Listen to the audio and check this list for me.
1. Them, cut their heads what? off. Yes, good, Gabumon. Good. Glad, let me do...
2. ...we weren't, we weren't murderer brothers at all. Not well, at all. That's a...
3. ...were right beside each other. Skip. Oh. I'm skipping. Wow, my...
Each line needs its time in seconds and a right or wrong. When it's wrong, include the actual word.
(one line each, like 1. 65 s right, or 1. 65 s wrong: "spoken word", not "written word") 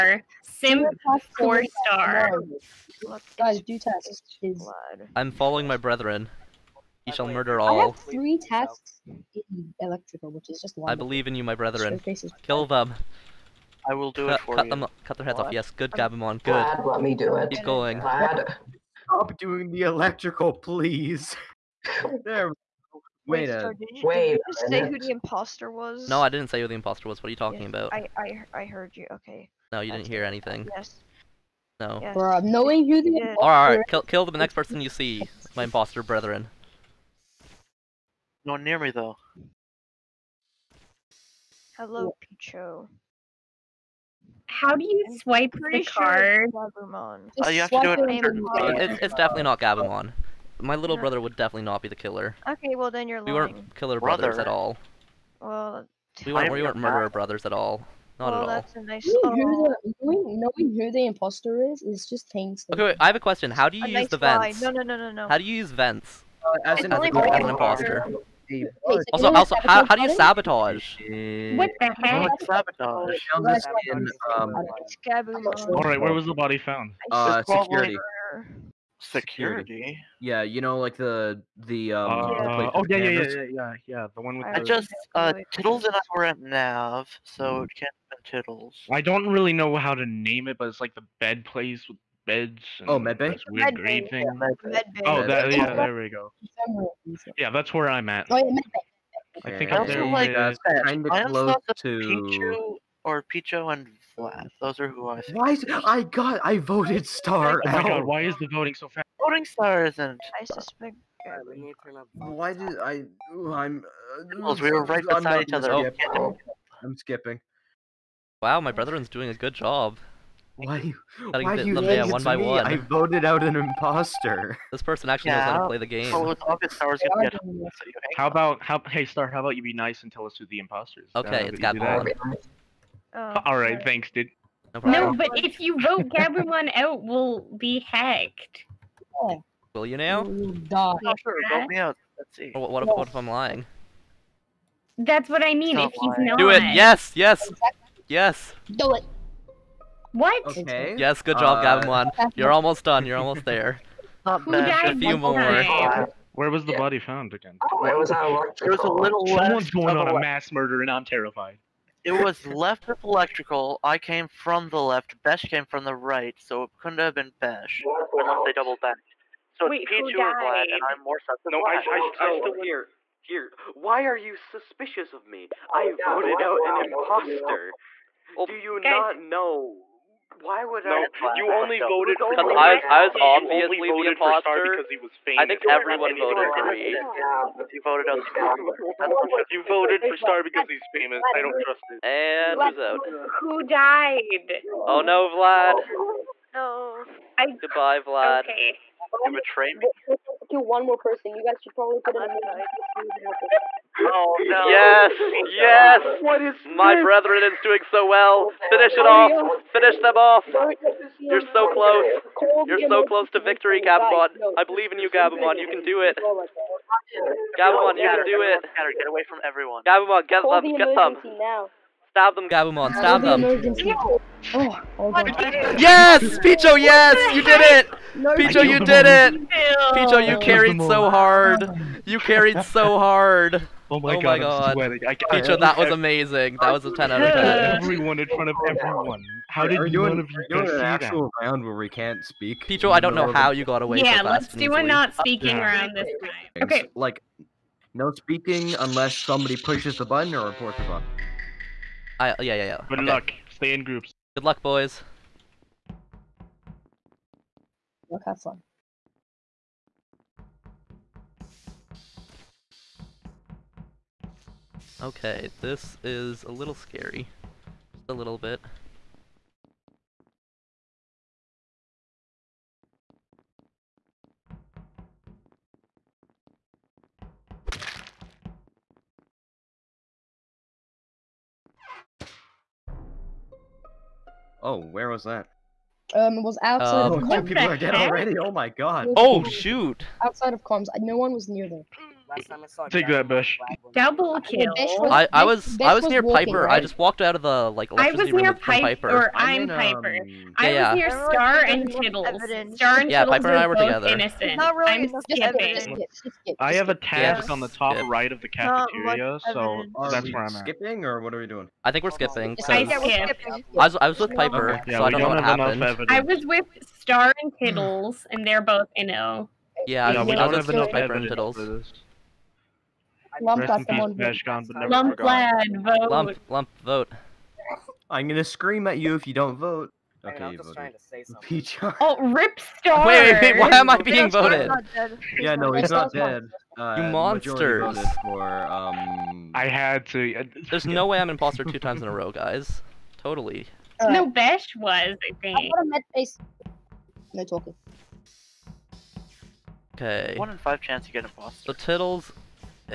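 1. 14 s right
2. 56 s right
3. 114 s right.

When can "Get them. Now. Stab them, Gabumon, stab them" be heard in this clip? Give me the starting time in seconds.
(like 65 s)
220 s.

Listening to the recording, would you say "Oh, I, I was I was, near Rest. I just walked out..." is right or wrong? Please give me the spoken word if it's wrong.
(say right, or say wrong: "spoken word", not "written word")
wrong: "Piper", not "Rest".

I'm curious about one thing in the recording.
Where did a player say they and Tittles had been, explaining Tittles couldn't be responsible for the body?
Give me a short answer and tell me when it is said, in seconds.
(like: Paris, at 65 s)
Nav, at 86 s.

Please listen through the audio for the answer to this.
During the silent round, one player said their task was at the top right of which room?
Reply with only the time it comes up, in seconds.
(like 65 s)
308 s.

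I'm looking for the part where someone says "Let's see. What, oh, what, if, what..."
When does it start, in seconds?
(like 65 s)
142 s.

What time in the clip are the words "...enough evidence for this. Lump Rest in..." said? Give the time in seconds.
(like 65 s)
320 s.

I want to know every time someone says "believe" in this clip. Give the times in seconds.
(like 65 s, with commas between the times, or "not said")
10 s, 214 s.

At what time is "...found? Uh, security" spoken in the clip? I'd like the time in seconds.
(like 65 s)
76 s.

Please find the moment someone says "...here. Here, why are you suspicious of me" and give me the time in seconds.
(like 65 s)
172 s.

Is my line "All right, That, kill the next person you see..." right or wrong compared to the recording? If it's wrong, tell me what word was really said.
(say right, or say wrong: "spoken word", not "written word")
wrong: "Kill", not "That".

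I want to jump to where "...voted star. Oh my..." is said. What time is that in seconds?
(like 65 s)
106 s.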